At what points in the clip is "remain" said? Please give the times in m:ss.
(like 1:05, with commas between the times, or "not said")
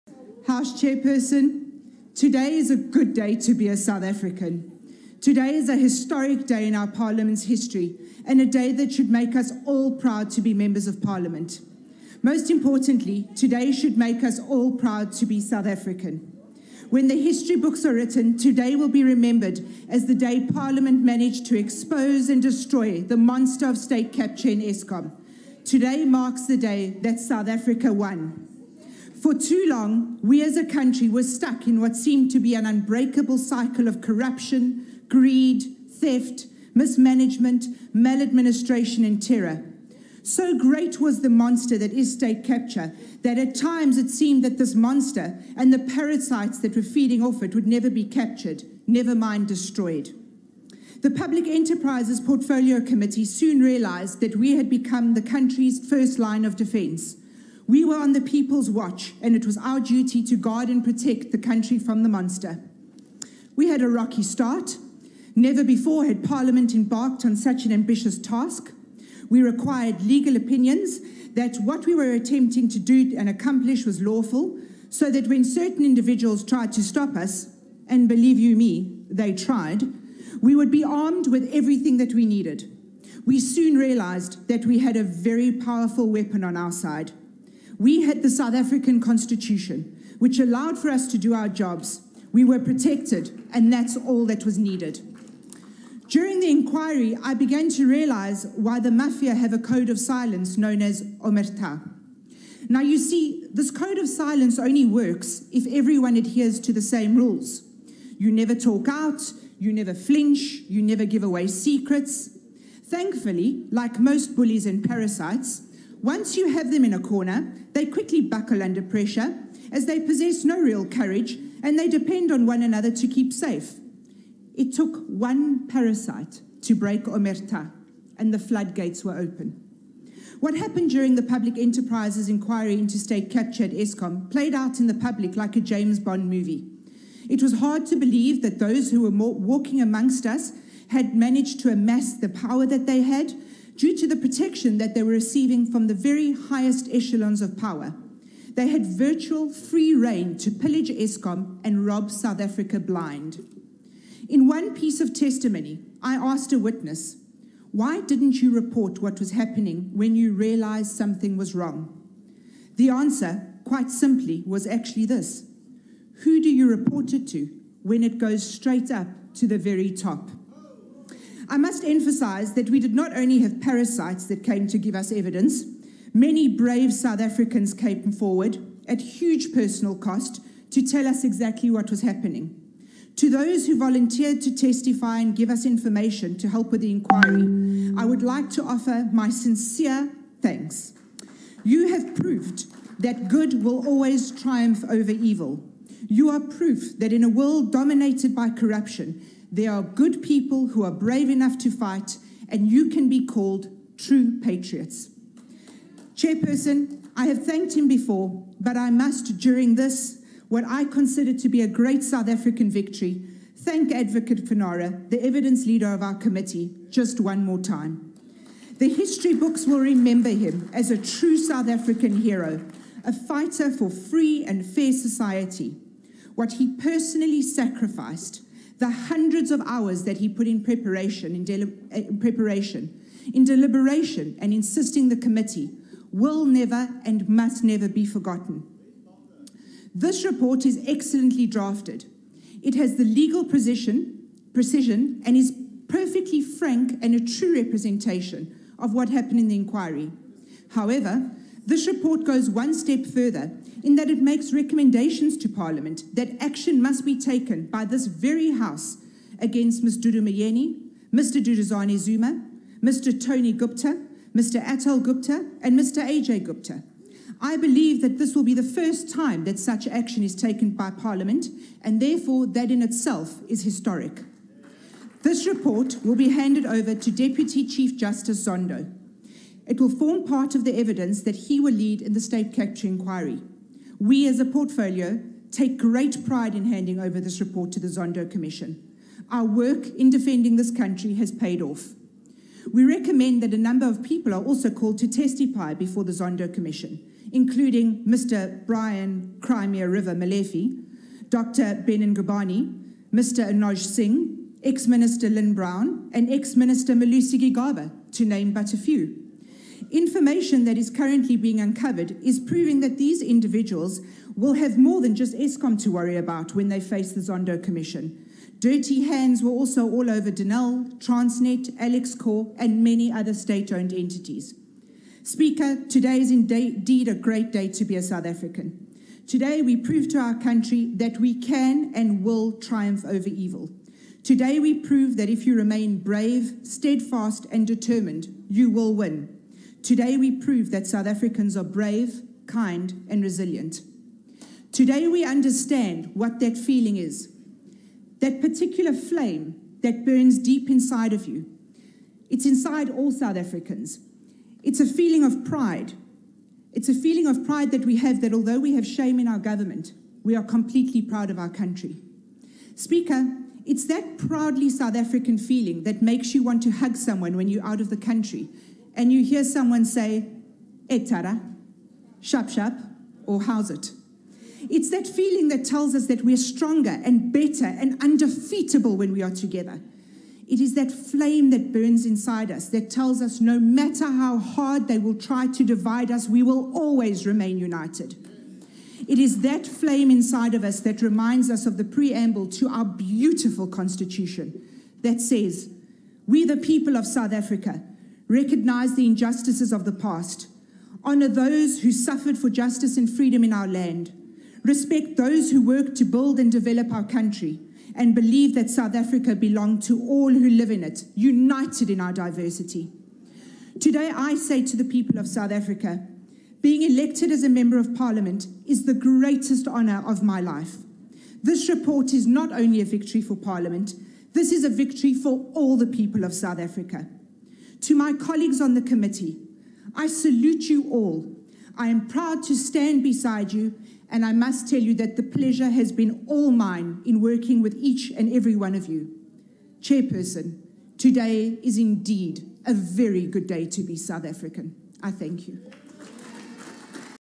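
5:35, 6:27.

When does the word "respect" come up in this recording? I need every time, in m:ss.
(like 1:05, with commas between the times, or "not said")
6:44.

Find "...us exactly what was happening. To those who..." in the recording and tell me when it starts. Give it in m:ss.
3:01.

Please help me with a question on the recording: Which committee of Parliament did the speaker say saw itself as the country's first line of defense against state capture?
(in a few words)
Public Enterprises Portfolio Committee.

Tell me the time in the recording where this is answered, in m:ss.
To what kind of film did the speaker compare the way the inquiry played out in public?
2:15.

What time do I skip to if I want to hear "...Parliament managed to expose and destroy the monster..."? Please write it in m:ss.
0:20.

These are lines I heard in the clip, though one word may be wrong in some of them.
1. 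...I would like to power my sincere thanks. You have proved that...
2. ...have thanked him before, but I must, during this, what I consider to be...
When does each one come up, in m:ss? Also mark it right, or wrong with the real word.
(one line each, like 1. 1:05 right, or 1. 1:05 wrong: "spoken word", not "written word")
1. 3:07 wrong: "offer", not "power"
2. 3:27 right.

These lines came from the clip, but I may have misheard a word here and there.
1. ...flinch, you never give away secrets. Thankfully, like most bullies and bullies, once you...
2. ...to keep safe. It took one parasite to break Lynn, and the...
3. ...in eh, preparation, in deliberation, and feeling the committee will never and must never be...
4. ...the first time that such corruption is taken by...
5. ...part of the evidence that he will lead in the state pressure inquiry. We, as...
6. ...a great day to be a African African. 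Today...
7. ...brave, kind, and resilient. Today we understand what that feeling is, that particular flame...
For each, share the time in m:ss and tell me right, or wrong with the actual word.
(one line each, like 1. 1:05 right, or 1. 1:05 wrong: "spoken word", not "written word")
1. 1:49 wrong: "parasites", not "bullies"
2. 2:02 wrong: "Omerta", not "Lynn"
3. 3:51 wrong: "insisting", not "feeling"
4. 4:28 wrong: "action", not "corruption"
5. 4:40 wrong: "capture", not "pressure"
6. 5:27 wrong: "South", not "African"
7. 5:41 right.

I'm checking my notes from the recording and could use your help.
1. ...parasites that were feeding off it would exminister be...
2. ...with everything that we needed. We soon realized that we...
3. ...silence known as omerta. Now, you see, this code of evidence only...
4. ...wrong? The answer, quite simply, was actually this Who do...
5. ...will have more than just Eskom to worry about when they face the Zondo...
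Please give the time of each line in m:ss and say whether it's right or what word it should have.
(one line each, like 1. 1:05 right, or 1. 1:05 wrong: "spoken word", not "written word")
1. 0:45 wrong: "never", not "exminister"
2. 1:21 right
3. 1:39 wrong: "silence", not "evidence"
4. 2:41 right
5. 5:14 right.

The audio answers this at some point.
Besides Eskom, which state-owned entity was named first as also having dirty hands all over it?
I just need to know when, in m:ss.
5:20.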